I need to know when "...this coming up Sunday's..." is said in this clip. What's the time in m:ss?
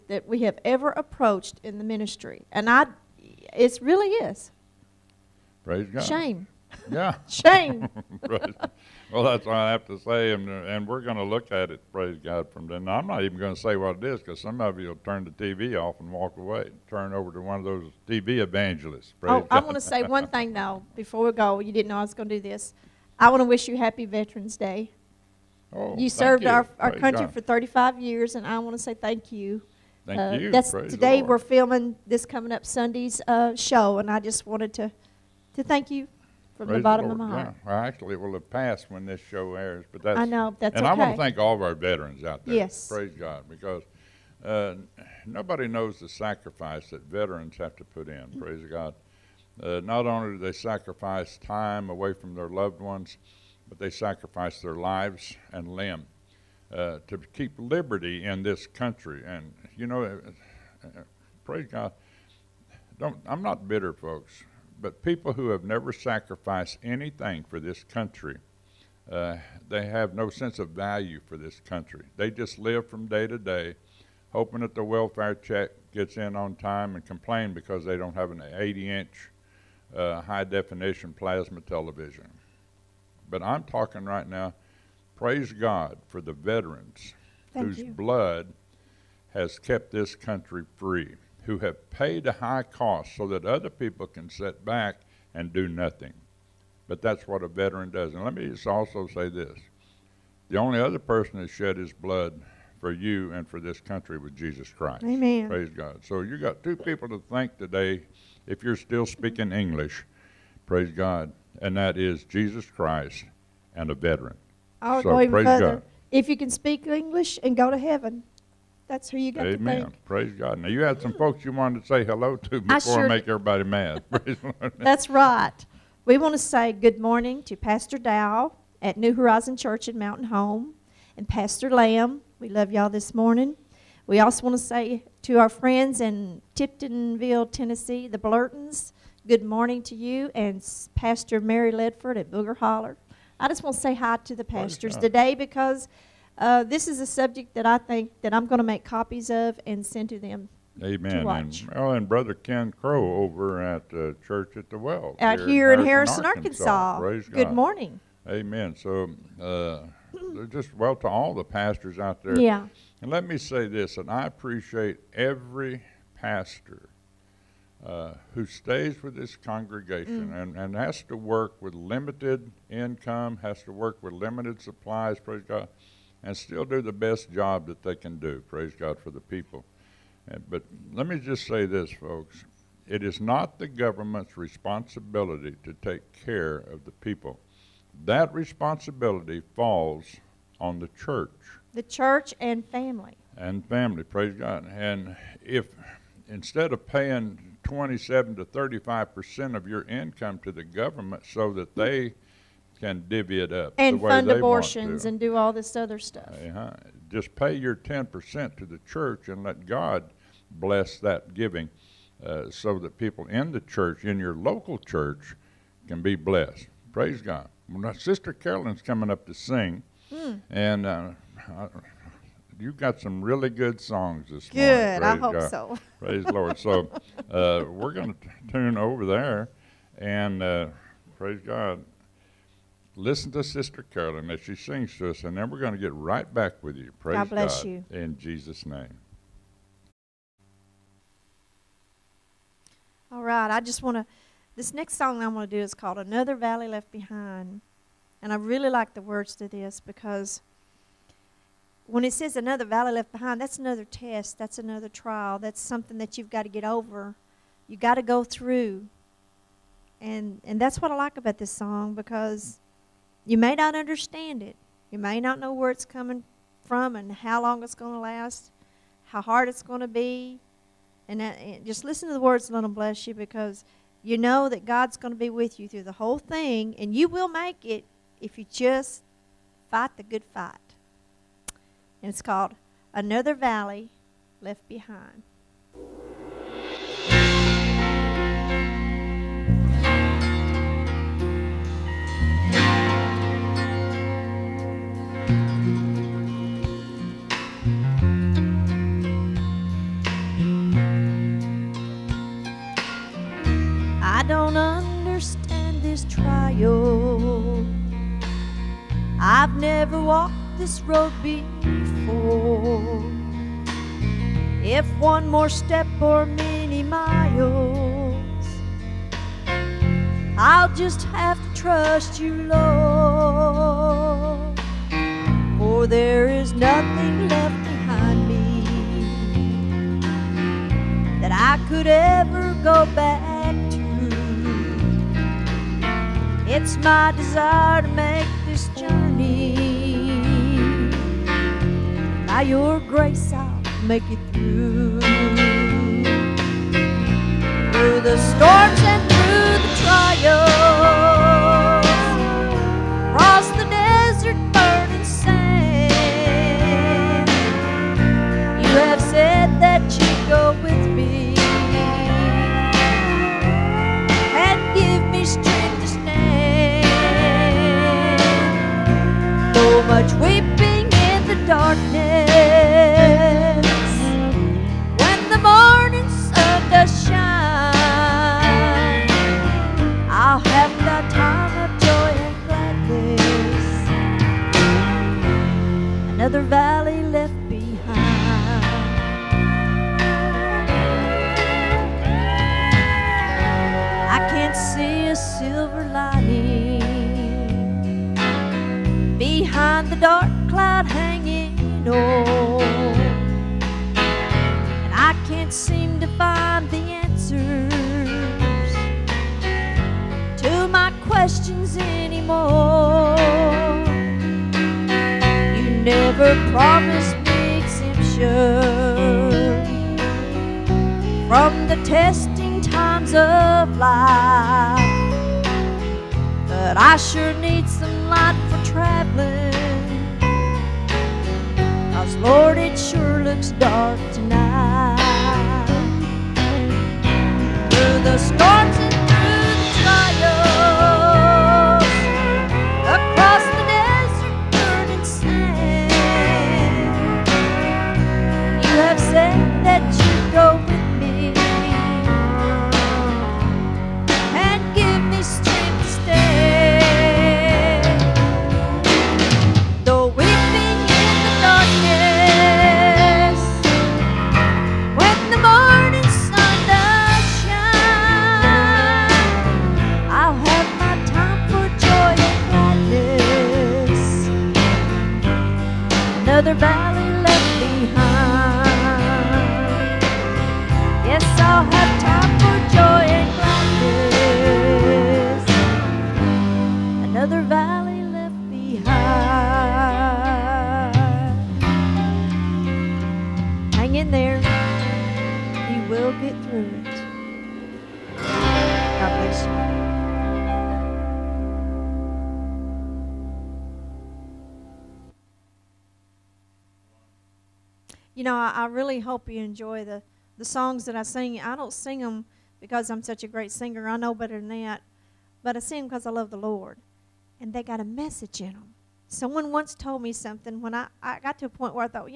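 0:32.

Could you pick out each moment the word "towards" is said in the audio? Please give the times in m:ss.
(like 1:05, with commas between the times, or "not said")
not said.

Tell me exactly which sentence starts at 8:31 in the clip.
I don't sing them because I'm such a great singer.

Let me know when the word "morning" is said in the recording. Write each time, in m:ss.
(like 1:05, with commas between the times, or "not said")
2:06, 2:13, 2:19, 2:37, 3:44.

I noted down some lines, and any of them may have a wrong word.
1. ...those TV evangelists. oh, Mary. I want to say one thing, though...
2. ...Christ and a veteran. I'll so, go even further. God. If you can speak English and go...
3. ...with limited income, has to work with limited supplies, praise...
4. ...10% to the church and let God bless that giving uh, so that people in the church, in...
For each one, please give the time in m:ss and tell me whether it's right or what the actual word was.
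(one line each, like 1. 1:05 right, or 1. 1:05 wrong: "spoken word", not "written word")
1. 0:17 wrong: "God", not "Mary"
2. 1:52 right
3. 2:51 right
4. 3:27 right.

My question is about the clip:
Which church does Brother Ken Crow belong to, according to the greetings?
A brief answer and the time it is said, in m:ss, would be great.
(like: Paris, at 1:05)
Church at the Well, at 2:34.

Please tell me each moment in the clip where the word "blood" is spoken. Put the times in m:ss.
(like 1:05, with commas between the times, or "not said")
1:27, 1:41.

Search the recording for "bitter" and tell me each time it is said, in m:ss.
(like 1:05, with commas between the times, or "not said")
1:03.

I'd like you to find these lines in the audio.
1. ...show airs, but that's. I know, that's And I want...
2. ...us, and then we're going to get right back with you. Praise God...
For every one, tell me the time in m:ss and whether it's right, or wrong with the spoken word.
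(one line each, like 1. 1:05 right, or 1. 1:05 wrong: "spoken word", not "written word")
1. 0:39 right
2. 3:55 right.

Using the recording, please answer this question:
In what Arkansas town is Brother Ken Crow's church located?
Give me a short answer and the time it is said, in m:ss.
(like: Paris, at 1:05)
Harrison, at 2:35.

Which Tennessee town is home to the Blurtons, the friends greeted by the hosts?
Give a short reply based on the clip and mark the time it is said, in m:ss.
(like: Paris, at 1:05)
Tiptonville, at 2:16.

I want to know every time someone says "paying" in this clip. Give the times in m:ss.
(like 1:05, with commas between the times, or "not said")
3:16.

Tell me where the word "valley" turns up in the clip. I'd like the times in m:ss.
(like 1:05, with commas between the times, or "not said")
4:06, 4:12, 4:43.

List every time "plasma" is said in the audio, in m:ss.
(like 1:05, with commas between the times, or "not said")
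1:21.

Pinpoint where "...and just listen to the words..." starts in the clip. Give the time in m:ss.
4:31.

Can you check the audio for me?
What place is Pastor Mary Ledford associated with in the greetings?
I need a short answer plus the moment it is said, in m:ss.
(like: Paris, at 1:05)
Booger Holler, at 2:22.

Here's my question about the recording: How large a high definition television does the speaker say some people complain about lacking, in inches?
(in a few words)
80.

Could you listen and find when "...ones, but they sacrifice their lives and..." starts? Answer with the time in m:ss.
0:52.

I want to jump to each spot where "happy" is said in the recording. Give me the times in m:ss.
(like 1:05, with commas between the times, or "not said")
0:23.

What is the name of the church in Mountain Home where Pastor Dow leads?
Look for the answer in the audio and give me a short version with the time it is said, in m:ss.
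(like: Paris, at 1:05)
New Horizon Church, at 2:08.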